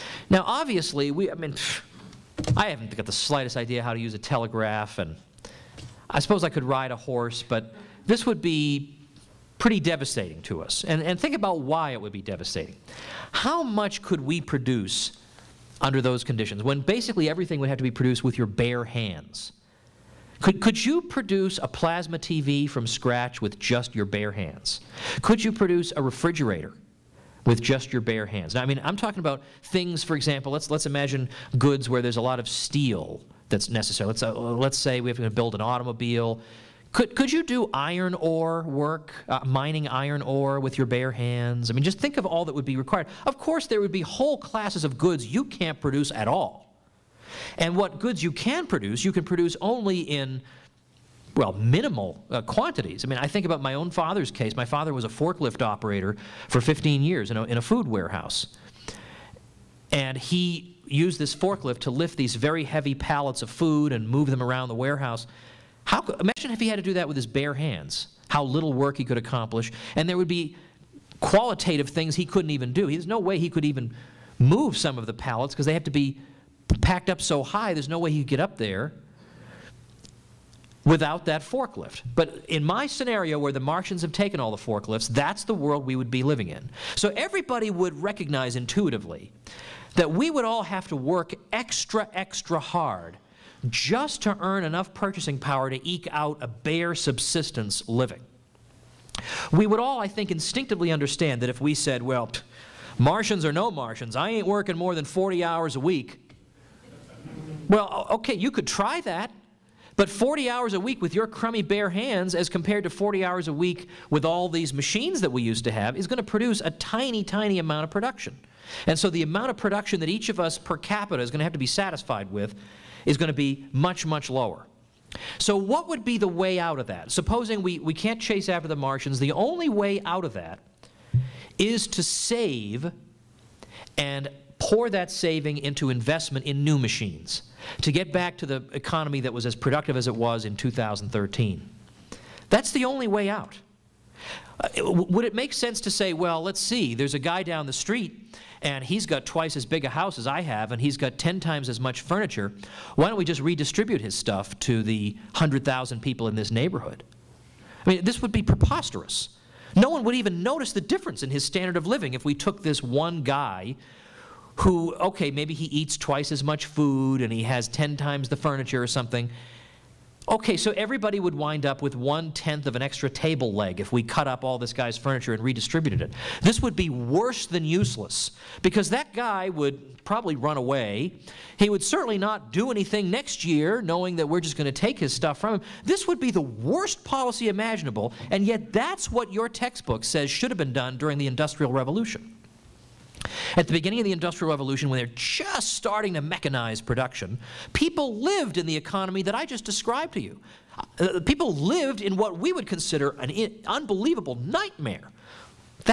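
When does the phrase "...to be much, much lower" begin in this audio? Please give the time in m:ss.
2:03.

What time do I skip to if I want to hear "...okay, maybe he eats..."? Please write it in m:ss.
2:44.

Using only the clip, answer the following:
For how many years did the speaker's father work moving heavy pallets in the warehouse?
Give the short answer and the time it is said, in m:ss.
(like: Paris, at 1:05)
15, at 0:56.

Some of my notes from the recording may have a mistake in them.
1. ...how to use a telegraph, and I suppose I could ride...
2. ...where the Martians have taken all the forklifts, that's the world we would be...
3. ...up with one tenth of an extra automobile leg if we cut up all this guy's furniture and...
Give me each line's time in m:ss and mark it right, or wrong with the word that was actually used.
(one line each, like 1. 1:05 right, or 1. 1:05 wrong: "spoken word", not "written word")
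1. 0:03 right
2. 1:23 right
3. 2:51 wrong: "table", not "automobile".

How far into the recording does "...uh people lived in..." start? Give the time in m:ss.
3:21.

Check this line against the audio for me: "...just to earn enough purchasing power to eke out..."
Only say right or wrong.
right.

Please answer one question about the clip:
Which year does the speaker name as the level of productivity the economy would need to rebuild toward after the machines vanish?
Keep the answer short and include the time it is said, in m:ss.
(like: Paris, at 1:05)
2013, at 2:20.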